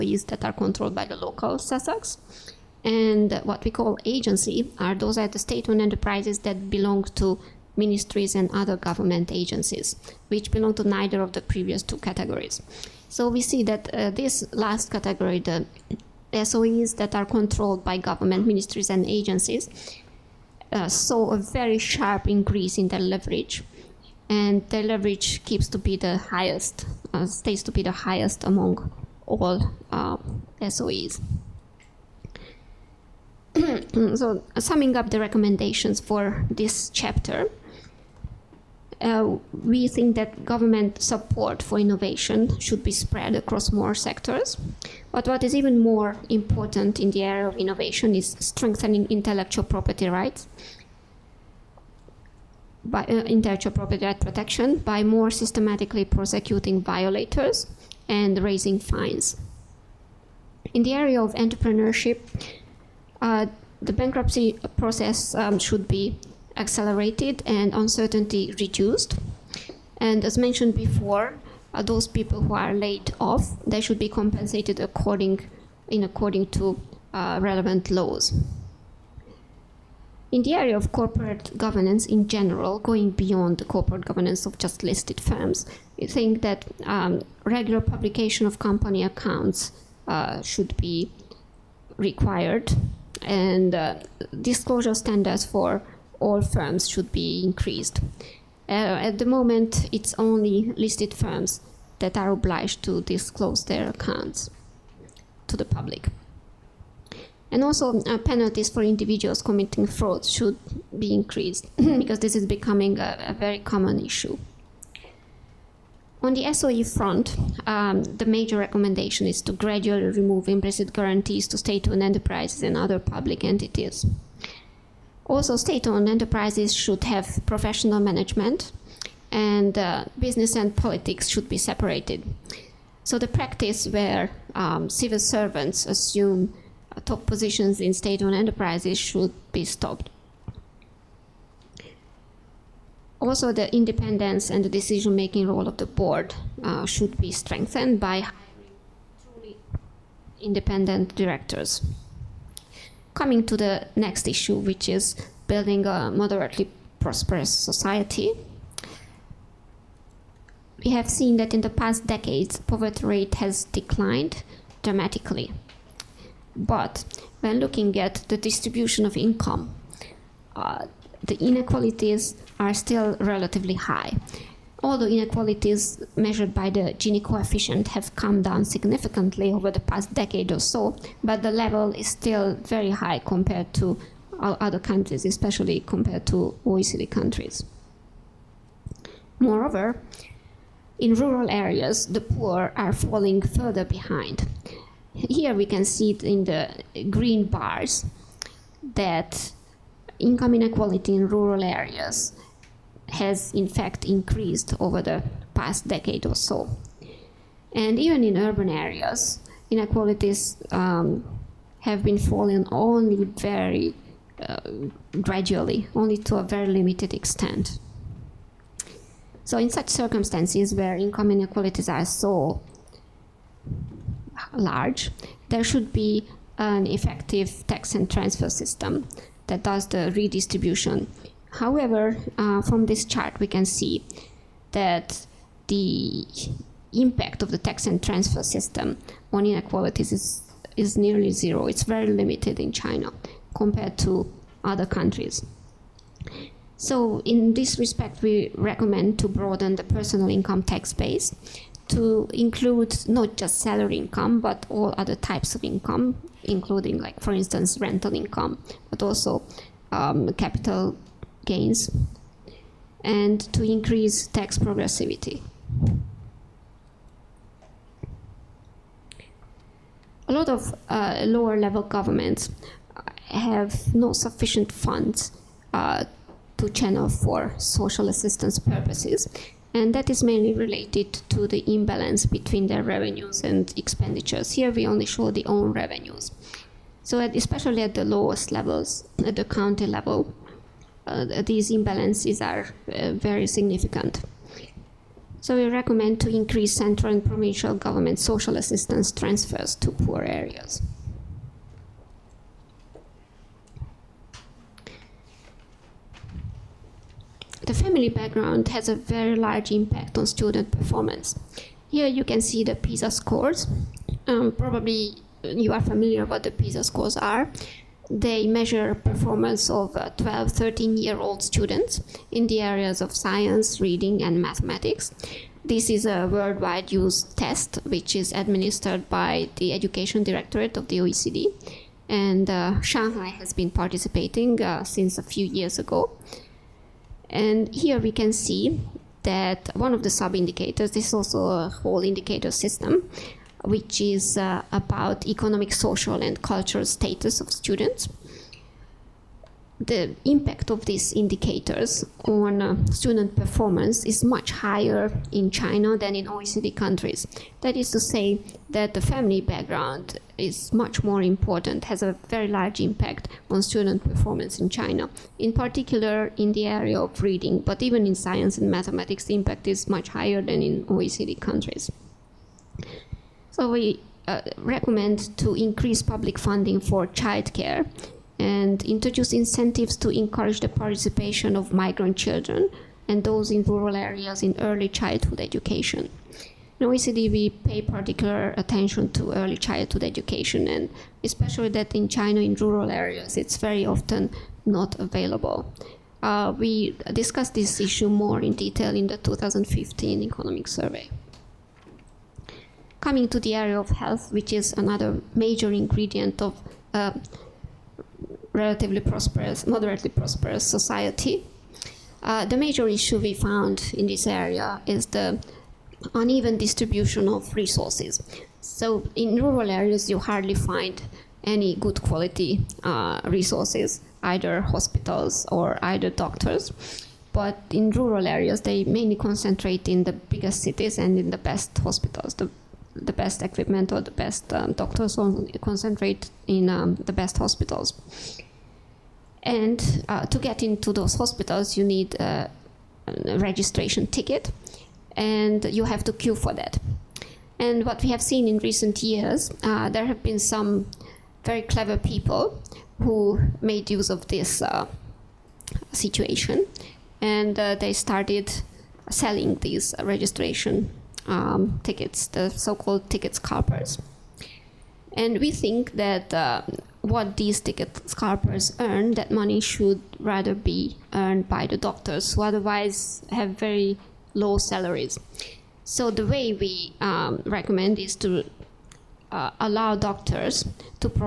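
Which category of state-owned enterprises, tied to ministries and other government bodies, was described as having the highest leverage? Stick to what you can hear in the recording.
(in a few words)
agency.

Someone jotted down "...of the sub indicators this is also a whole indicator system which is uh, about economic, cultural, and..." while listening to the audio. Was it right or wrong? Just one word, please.
wrong.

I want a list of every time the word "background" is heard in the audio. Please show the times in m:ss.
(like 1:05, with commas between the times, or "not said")
5:08, 5:59.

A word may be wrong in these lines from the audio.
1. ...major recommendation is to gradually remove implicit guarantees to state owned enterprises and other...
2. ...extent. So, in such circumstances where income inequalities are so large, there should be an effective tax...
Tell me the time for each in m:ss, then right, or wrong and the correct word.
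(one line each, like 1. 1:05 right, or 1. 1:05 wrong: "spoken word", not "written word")
1. 1:58 right
2. 3:37 right.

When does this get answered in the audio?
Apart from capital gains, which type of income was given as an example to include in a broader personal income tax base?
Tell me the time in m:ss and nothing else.
4:17.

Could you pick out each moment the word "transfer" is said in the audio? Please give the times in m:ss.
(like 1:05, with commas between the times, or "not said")
3:48, 3:58, 4:59.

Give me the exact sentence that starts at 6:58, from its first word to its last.
So in rural areas, you hardly find any good quality uh, resources, either hospitals or either doctors.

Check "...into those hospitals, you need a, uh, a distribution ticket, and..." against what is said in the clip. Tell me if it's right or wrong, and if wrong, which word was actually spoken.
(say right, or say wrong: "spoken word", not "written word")
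wrong: "registration", not "distribution".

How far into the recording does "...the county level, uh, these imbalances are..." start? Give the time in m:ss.
4:49.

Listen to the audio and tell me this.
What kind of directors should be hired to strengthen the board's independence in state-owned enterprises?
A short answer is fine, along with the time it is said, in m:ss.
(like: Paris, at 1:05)
truly independent directors, at 2:29.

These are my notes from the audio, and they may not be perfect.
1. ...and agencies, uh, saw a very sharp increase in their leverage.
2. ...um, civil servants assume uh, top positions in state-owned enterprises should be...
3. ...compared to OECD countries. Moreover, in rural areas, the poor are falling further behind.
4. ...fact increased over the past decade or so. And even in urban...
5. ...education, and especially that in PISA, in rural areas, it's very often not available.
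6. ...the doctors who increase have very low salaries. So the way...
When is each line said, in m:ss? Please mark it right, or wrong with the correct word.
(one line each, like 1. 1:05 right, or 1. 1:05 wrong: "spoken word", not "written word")
1. 0:18 right
2. 2:14 right
3. 3:05 right
4. 3:23 right
5. 6:30 wrong: "China", not "PISA"
6. 7:51 wrong: "otherwise", not "increase".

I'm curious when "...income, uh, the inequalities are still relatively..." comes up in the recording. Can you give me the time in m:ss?
2:49.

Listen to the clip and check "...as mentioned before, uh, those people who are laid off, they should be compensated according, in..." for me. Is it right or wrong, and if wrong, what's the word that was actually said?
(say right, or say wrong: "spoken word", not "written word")
right.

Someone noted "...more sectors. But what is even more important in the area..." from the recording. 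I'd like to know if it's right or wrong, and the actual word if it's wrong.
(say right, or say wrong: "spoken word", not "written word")
right.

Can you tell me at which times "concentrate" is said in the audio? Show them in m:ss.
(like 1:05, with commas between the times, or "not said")
7:09, 7:15.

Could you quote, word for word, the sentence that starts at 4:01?
It's very limited in China compared to other countries.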